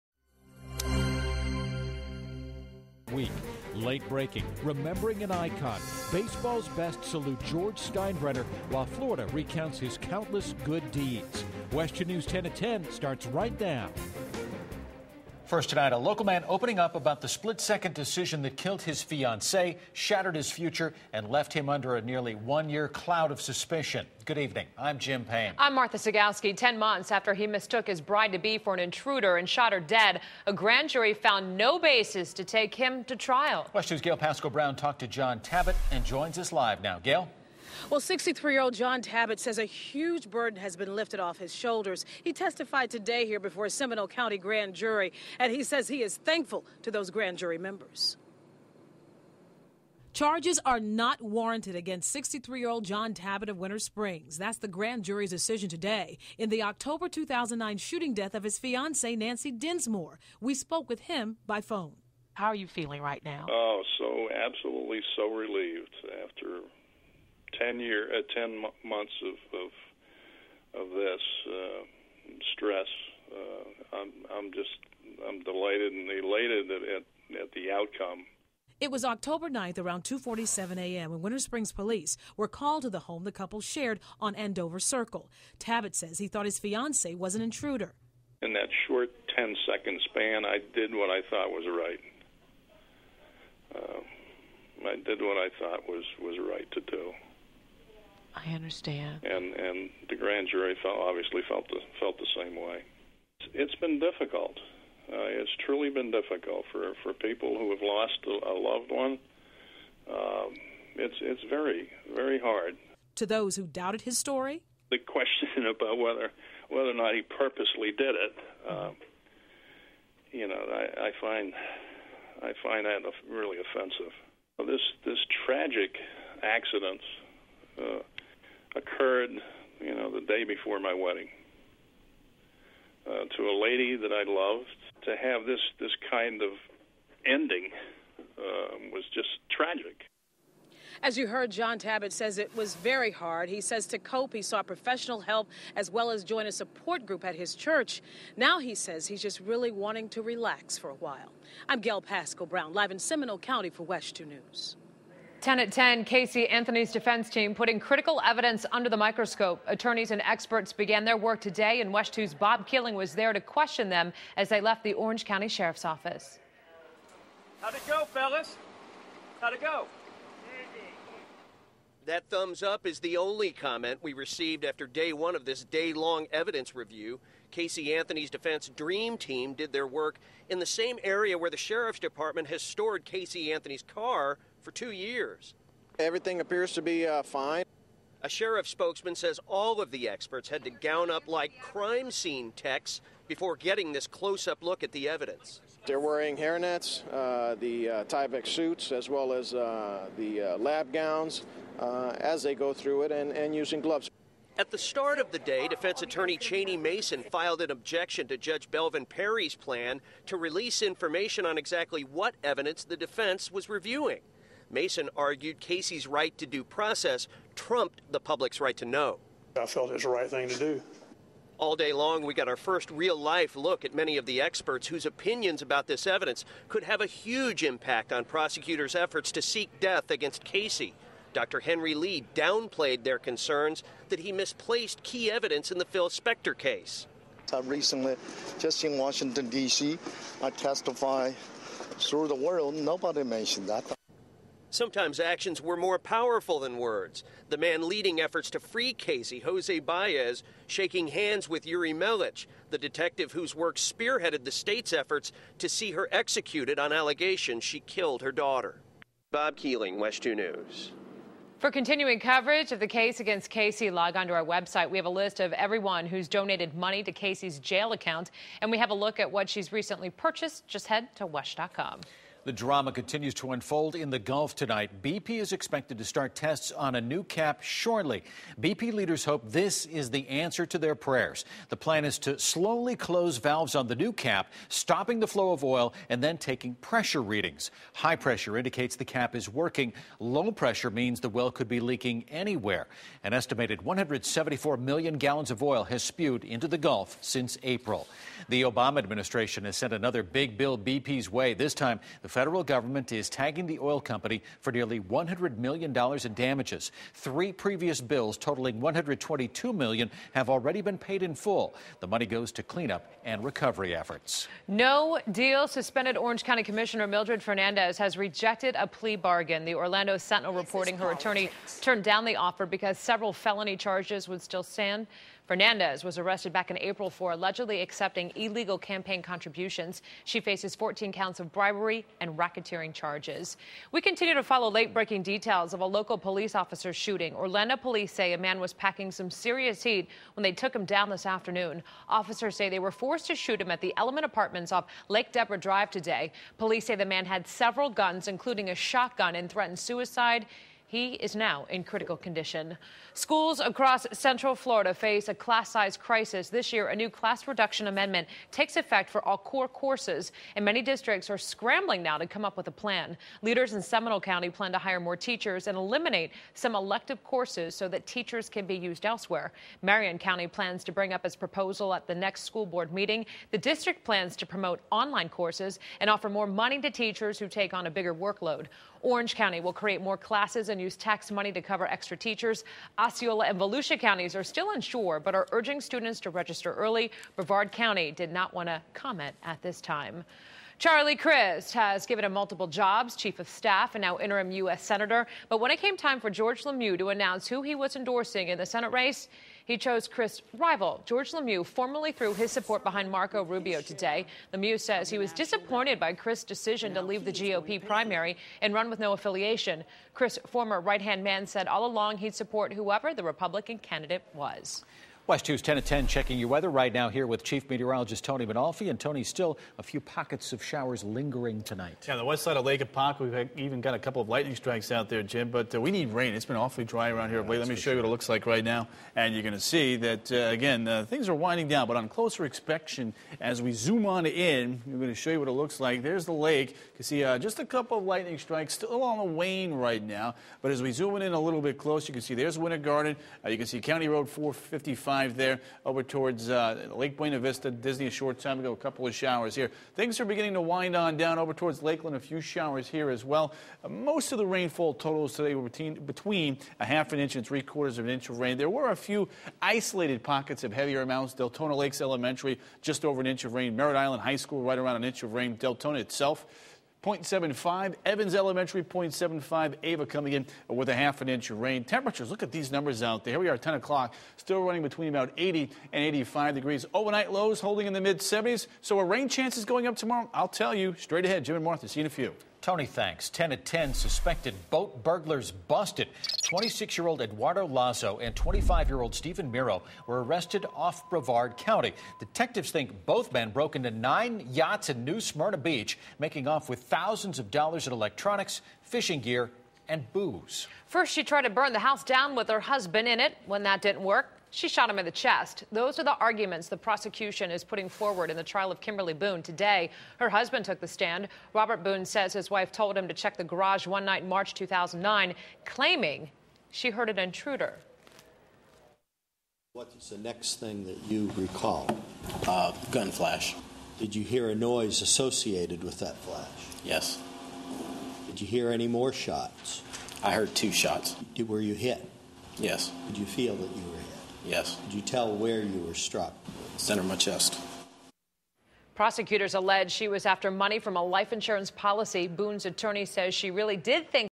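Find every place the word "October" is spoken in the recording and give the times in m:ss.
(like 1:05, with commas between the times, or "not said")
0:56, 1:19.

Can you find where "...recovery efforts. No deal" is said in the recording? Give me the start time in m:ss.
5:13.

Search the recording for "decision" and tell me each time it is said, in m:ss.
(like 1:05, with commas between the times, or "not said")
0:17, 0:55, 6:46.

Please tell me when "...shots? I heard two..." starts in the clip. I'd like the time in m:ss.
8:49.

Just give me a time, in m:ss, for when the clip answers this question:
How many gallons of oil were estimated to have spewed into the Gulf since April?
4:53.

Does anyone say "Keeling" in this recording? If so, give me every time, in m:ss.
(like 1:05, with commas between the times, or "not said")
2:42, 4:19.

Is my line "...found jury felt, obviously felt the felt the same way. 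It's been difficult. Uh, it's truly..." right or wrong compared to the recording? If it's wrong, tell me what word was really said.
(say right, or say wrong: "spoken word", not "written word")
wrong: "grand", not "found".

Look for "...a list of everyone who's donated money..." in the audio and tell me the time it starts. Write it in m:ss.
4:25.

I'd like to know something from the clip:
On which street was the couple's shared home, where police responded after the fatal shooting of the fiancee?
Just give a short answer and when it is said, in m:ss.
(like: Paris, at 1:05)
Andover Circle, at 1:24.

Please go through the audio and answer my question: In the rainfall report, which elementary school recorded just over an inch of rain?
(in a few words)
Deltona Lakes Elementary.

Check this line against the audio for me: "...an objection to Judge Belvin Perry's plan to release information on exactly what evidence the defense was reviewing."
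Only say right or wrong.
right.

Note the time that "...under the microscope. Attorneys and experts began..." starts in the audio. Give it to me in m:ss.
2:38.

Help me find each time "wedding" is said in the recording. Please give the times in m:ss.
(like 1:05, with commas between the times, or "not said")
2:10.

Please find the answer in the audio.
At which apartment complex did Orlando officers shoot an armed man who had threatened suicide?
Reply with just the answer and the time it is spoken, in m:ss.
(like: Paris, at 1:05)
Element Apartments, at 5:43.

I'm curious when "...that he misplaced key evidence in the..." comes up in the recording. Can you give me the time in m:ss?
3:54.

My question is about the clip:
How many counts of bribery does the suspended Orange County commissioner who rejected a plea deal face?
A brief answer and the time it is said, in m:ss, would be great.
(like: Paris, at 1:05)
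14, at 5:30.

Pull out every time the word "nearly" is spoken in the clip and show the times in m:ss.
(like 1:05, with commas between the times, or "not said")
0:22, 5:04.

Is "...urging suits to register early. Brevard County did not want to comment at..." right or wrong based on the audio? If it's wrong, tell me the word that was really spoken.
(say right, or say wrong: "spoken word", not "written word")
wrong: "students", not "suits".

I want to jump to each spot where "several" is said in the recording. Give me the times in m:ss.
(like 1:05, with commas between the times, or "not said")
5:22, 5:47.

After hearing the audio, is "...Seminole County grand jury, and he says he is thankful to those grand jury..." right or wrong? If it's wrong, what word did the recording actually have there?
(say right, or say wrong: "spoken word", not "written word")
right.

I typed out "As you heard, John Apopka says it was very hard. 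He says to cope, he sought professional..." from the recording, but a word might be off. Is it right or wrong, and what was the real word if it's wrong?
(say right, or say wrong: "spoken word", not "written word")
wrong: "Tabbitt", not "Apopka".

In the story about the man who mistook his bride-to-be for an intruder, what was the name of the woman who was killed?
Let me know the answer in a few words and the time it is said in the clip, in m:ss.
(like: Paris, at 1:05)
Nancy Dinsmore, at 0:59.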